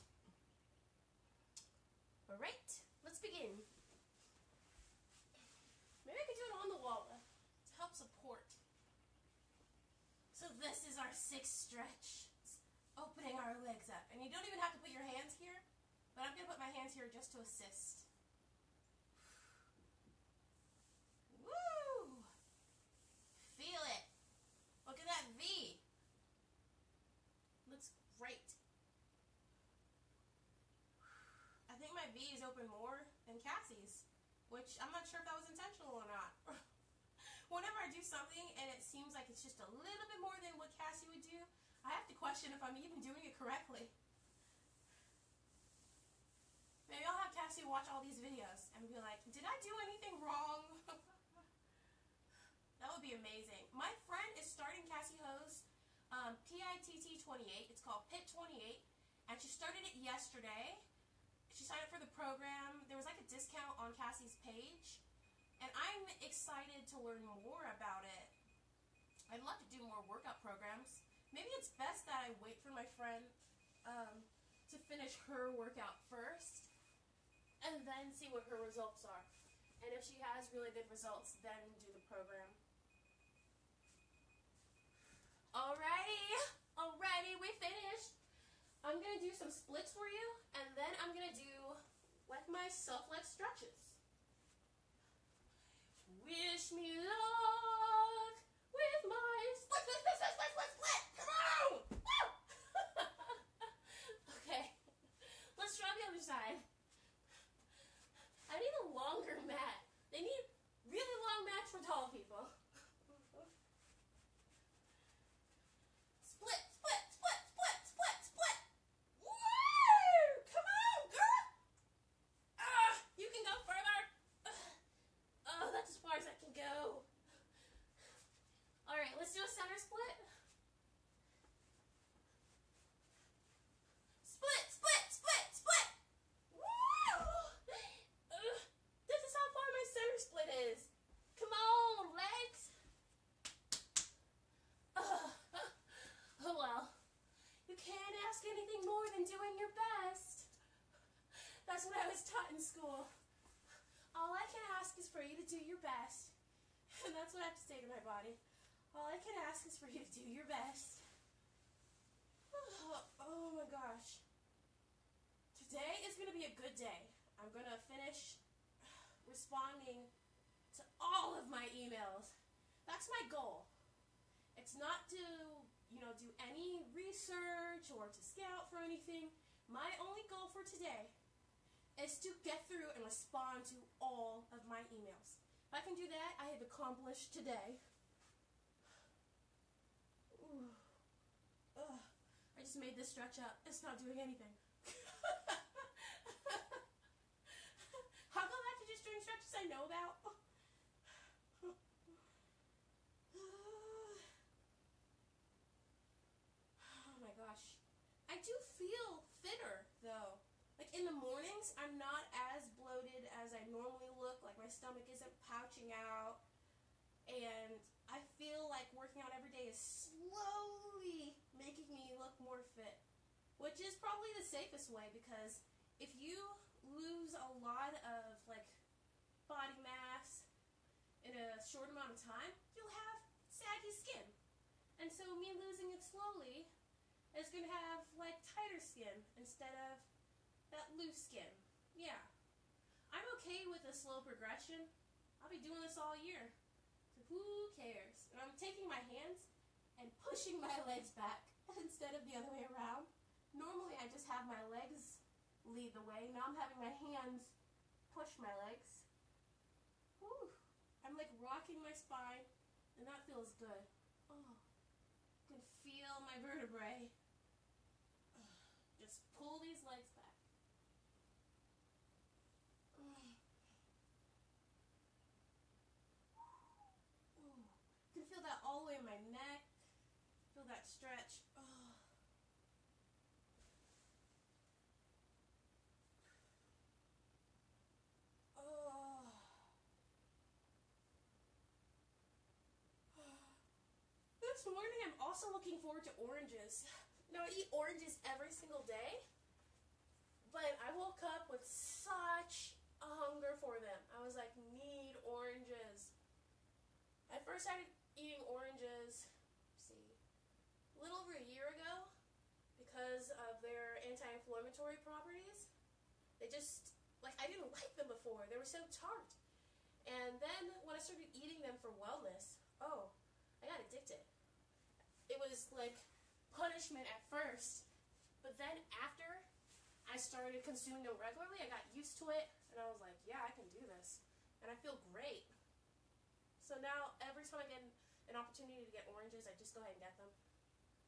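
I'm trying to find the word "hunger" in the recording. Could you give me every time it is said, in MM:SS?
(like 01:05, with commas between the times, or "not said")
05:03.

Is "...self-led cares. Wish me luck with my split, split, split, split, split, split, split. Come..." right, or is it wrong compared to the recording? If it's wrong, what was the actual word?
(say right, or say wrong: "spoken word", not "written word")
wrong: "stretches", not "cares".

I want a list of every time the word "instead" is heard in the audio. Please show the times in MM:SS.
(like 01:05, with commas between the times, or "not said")
03:59, 04:11.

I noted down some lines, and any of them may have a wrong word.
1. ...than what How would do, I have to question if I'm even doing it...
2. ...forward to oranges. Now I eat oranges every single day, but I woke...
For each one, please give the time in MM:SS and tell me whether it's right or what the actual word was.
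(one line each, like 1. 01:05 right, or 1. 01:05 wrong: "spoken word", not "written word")
1. 00:40 wrong: "Cassey", not "How"
2. 04:55 right.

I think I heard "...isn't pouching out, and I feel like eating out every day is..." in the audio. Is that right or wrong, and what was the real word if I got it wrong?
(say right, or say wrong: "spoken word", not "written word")
wrong: "working", not "eating".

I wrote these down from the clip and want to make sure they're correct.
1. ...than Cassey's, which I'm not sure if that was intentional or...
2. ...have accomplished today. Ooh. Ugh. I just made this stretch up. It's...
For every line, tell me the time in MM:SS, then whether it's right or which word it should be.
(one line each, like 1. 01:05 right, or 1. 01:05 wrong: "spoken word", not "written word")
1. 00:33 right
2. 03:06 right.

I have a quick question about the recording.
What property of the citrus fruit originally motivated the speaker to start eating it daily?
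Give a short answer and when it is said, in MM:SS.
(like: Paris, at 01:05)
anti-inflammatory, at 05:14.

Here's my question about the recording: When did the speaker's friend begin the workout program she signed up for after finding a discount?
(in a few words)
yesterday.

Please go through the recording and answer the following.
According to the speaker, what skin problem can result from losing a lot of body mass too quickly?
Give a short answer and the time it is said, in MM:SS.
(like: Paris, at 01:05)
saggy skin, at 03:53.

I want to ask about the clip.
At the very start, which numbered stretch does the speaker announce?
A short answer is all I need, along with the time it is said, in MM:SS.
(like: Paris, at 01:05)
sixth, at 00:11.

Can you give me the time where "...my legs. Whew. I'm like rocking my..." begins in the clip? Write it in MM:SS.
04:18.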